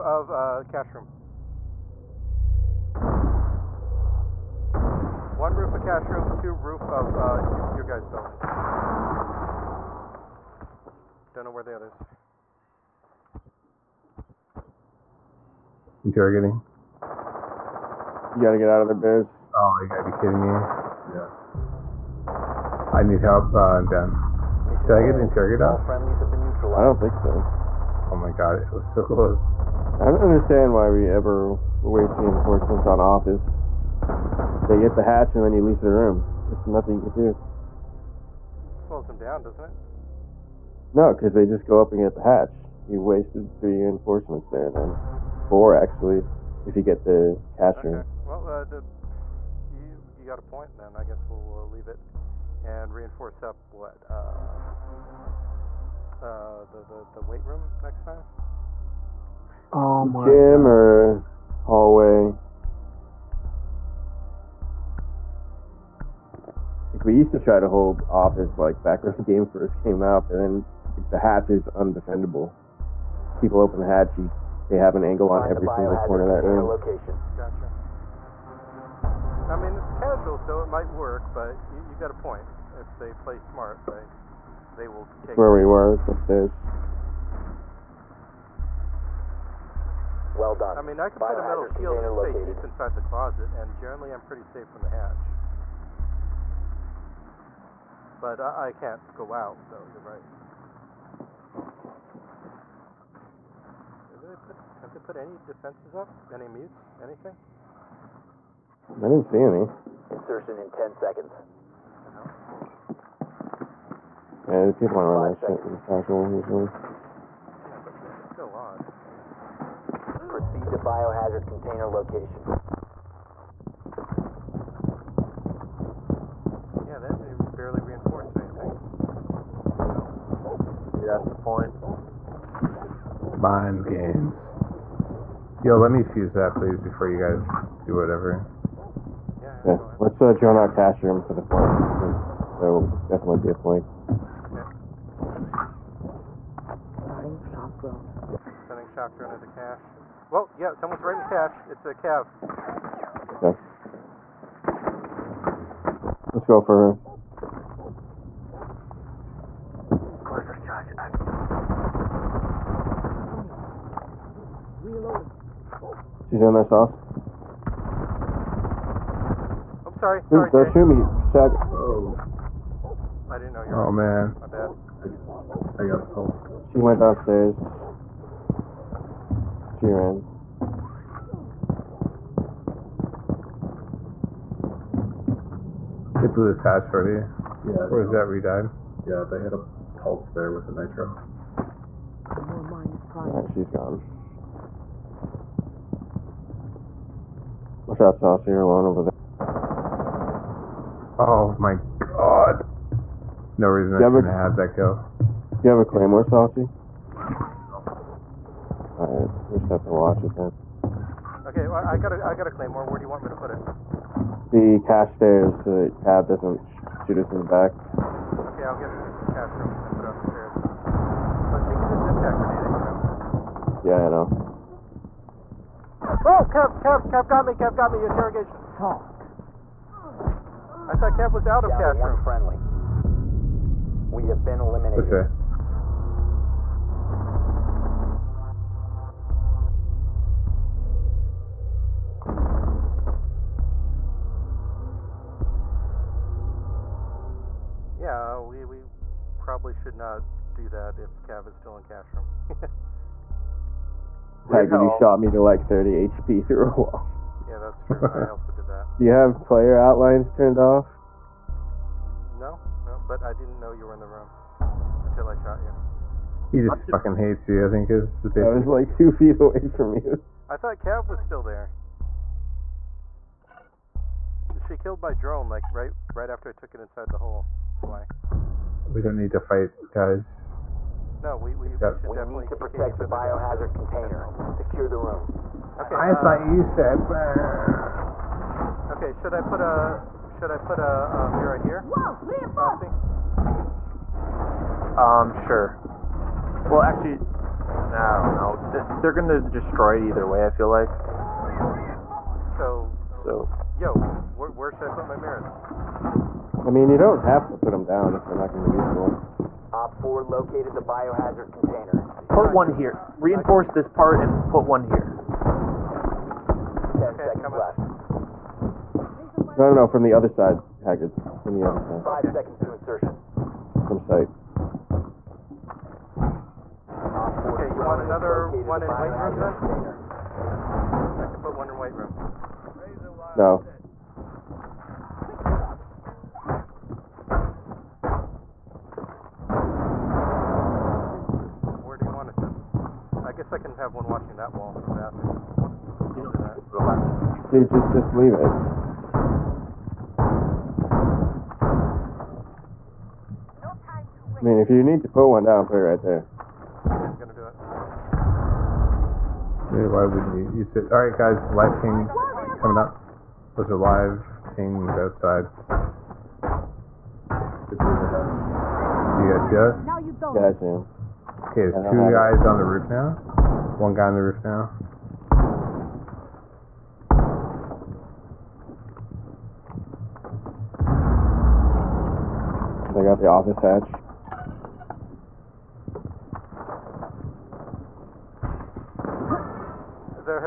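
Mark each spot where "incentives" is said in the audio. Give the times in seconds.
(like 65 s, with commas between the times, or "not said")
not said.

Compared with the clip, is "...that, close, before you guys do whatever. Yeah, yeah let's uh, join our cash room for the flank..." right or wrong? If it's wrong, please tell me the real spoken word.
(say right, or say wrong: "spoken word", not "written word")
wrong: "please", not "close".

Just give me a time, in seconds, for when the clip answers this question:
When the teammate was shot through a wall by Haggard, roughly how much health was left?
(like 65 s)
255 s.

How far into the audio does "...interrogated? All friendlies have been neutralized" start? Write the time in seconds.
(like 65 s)
25 s.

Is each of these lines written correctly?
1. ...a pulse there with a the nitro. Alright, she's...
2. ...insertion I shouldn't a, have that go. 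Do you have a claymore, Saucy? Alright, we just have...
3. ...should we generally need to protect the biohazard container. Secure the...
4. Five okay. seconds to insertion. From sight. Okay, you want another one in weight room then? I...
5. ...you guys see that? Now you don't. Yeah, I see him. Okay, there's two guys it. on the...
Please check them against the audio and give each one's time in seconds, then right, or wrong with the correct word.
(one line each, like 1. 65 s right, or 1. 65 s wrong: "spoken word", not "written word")
1. 189 s right
2. 203 s wrong: "reason", not "insertion"
3. 281 s wrong: "definitely", not "generally"
4. 322 s right
5. 367 s right.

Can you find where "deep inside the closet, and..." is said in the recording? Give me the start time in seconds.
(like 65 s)
92 s.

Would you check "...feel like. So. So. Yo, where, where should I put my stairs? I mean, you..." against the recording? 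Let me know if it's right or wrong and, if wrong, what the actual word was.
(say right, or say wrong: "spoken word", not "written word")
wrong: "mirrors", not "stairs".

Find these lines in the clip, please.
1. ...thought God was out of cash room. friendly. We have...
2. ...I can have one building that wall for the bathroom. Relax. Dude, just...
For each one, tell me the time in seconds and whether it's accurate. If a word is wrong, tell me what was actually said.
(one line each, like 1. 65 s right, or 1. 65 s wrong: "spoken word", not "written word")
1. 230 s wrong: "Kev", not "God"
2. 343 s wrong: "watching", not "building".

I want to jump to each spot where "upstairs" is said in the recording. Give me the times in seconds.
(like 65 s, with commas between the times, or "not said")
86 s.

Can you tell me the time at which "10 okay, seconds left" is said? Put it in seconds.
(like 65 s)
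316 s.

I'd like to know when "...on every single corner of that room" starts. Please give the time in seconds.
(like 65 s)
75 s.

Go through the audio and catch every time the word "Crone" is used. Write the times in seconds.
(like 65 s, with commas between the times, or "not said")
not said.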